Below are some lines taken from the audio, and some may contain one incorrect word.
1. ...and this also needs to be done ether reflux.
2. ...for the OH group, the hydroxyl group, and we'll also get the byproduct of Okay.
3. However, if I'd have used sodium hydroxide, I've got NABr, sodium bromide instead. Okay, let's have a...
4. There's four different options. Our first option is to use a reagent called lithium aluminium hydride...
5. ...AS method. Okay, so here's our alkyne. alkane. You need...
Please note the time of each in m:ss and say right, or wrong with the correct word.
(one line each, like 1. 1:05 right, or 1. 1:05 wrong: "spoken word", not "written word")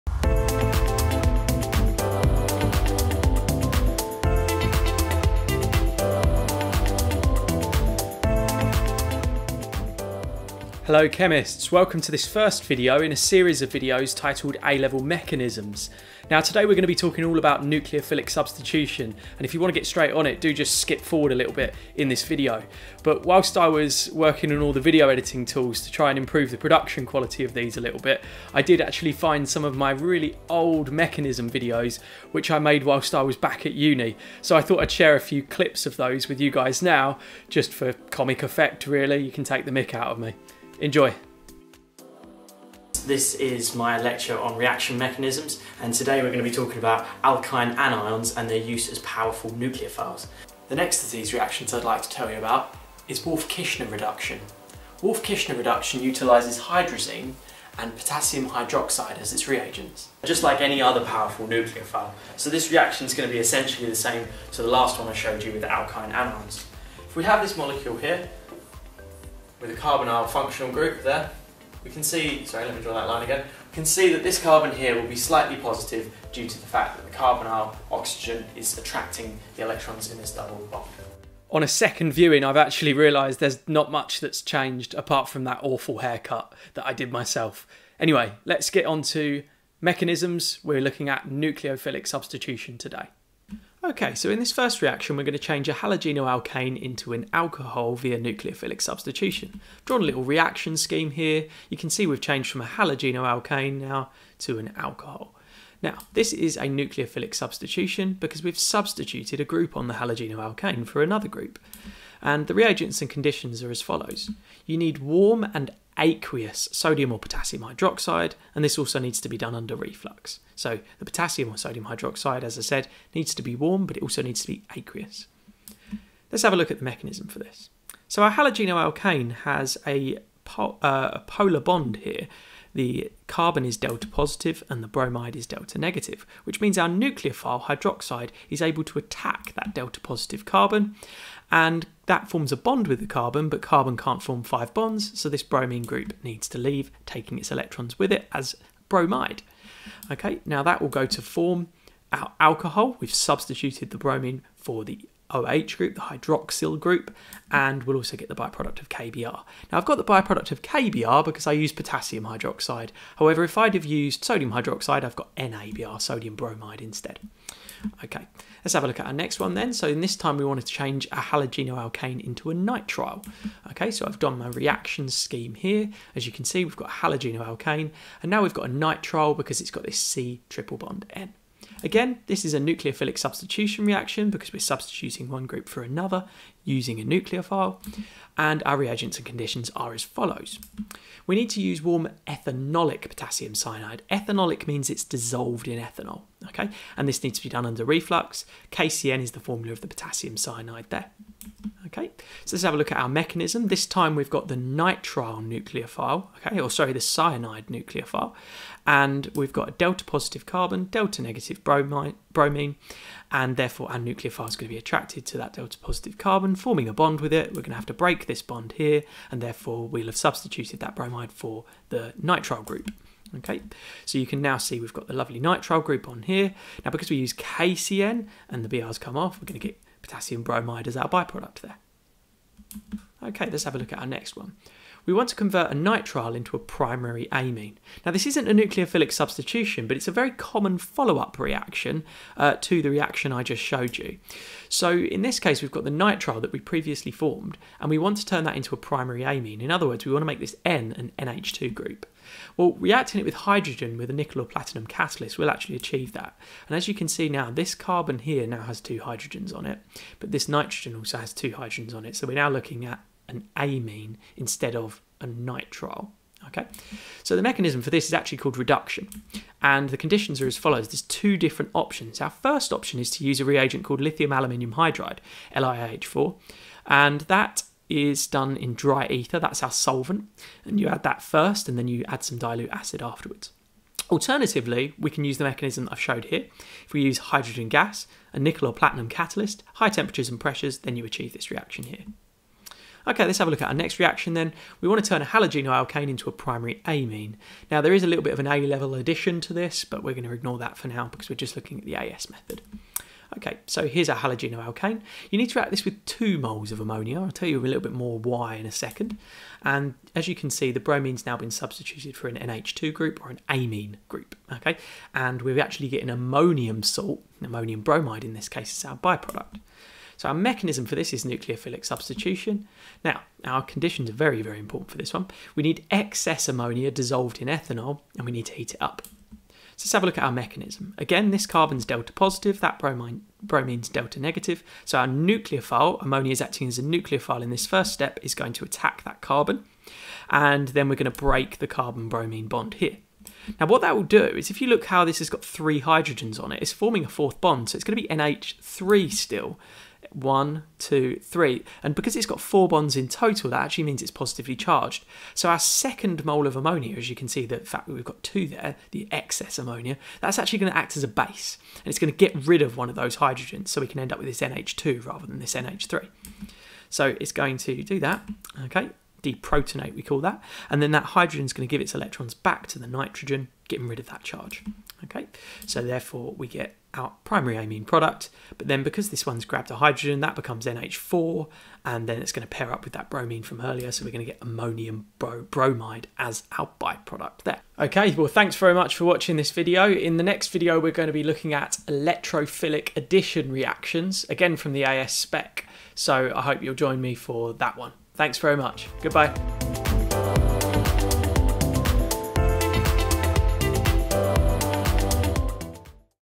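1. 1:58 wrong: "under", not "ether"
2. 2:34 wrong: "KBr", not "Okay"
3. 2:43 right
4. 4:30 wrong: "two", not "four"
5. 5:01 wrong: "halogenoalkane", not "alkyne".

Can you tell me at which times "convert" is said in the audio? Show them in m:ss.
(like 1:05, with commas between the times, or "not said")
3:55.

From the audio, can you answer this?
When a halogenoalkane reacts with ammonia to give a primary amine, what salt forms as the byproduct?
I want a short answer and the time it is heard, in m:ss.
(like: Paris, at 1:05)
ammonium bromide, at 5:17.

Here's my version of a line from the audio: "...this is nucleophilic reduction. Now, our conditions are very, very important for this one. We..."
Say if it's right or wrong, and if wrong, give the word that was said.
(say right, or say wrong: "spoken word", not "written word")
wrong: "substitution", not "reduction".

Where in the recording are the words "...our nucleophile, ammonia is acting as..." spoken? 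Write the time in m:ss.
5:34.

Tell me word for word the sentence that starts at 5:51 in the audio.
And because it's got four bonds in total, that actually means it's positively charged.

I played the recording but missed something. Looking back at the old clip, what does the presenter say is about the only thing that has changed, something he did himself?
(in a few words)
awful haircut.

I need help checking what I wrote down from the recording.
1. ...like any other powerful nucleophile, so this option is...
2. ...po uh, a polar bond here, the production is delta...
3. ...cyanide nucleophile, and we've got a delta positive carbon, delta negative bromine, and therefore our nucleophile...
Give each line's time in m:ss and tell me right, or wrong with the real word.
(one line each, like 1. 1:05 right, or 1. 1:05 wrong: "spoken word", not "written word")
1. 1:00 wrong: "reaction", not "option"
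2. 2:10 wrong: "carbon", not "production"
3. 3:27 right.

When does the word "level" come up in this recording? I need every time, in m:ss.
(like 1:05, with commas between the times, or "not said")
0:14, 4:58.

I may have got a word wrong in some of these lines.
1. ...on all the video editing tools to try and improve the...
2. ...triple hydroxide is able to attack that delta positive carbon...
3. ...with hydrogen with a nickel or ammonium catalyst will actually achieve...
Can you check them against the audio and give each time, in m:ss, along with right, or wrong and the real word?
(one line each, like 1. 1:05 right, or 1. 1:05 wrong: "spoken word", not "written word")
1. 0:24 right
2. 2:16 wrong: "nucleophile", not "triple"
3. 4:13 wrong: "platinum", not "ammonium".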